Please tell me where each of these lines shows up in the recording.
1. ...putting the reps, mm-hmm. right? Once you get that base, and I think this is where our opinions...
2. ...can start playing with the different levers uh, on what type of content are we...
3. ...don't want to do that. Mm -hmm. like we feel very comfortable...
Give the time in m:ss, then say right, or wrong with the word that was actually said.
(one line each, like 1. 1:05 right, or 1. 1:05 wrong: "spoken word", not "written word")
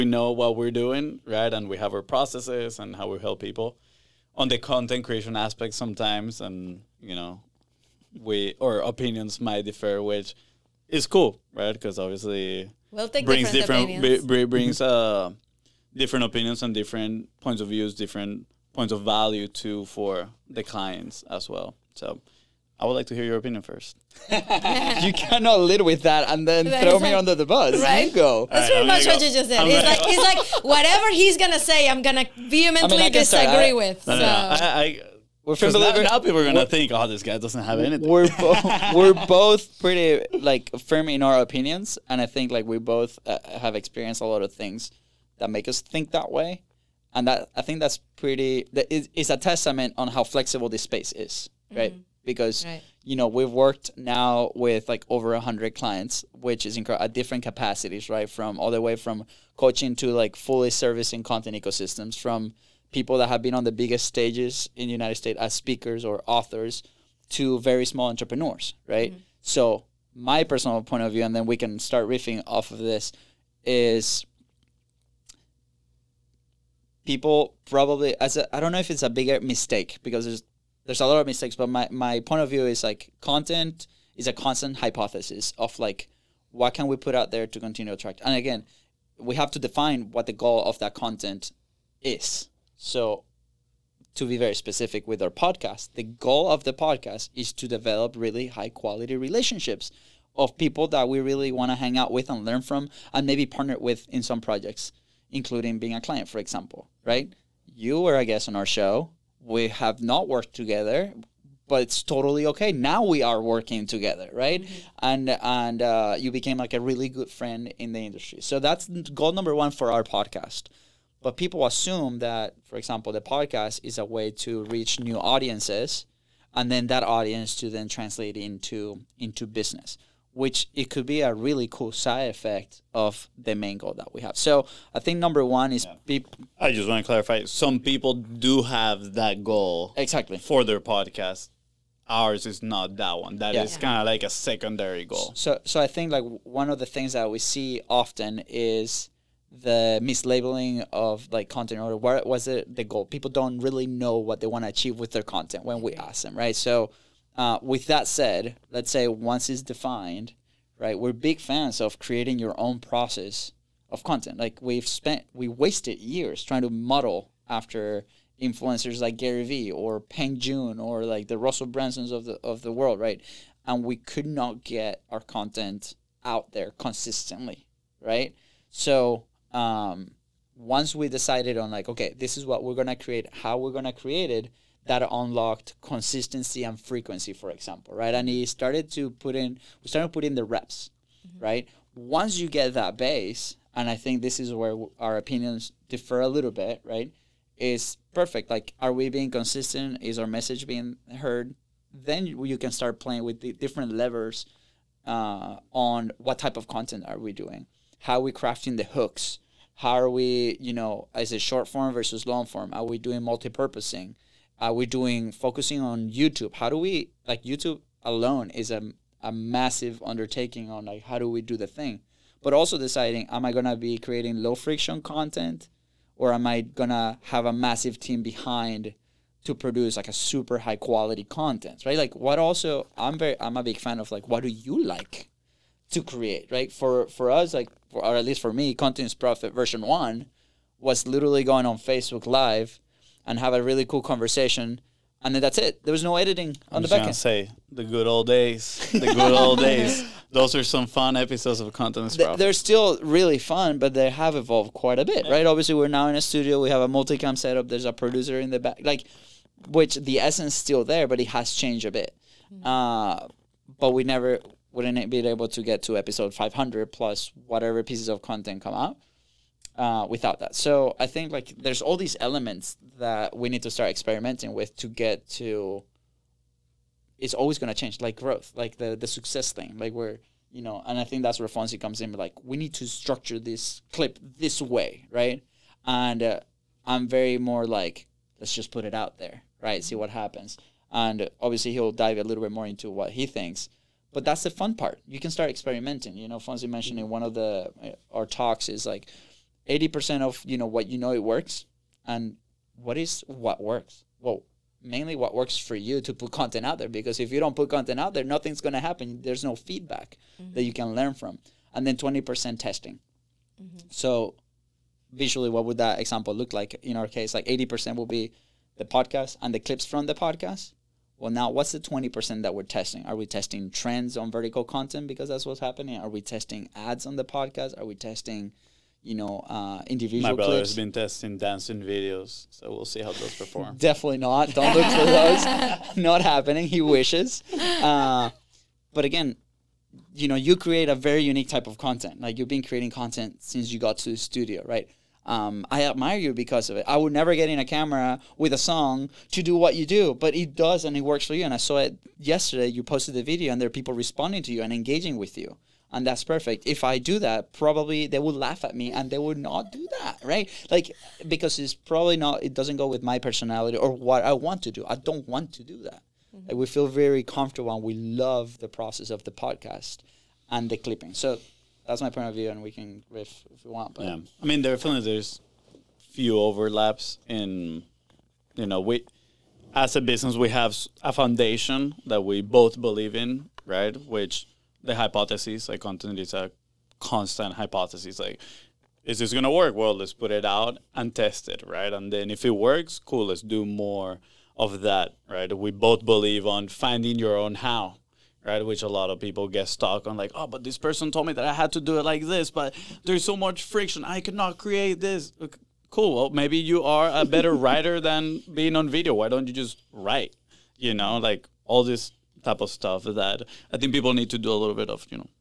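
1. 3:10 right
2. 3:22 right
3. 6:04 right.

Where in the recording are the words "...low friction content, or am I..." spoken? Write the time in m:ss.
3:44.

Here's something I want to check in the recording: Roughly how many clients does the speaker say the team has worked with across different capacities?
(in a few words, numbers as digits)
over 100.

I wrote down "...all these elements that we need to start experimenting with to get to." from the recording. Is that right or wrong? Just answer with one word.
right.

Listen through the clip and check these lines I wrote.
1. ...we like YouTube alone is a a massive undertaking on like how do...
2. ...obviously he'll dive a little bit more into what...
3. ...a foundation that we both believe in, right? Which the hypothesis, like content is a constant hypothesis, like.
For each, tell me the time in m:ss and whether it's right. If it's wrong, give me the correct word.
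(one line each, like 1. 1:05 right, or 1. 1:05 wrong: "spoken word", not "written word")
1. 3:36 right
2. 4:51 right
3. 6:21 right.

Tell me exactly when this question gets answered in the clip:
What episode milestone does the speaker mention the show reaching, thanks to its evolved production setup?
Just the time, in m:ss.
4:25.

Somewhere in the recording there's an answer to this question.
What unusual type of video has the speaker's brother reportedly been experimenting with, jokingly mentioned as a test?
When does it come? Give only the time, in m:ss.
5:31.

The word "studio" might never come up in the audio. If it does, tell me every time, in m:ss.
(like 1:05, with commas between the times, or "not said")
4:16, 5:44.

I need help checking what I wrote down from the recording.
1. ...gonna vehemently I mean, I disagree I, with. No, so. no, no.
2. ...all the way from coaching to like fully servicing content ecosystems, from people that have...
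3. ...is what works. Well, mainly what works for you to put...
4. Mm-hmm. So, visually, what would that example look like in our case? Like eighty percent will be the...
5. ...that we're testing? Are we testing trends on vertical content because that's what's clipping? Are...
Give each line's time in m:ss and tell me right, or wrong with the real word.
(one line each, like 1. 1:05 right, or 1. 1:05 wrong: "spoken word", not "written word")
1. 0:32 right
2. 0:58 right
3. 5:02 right
4. 5:13 right
5. 5:22 wrong: "happening", not "clipping".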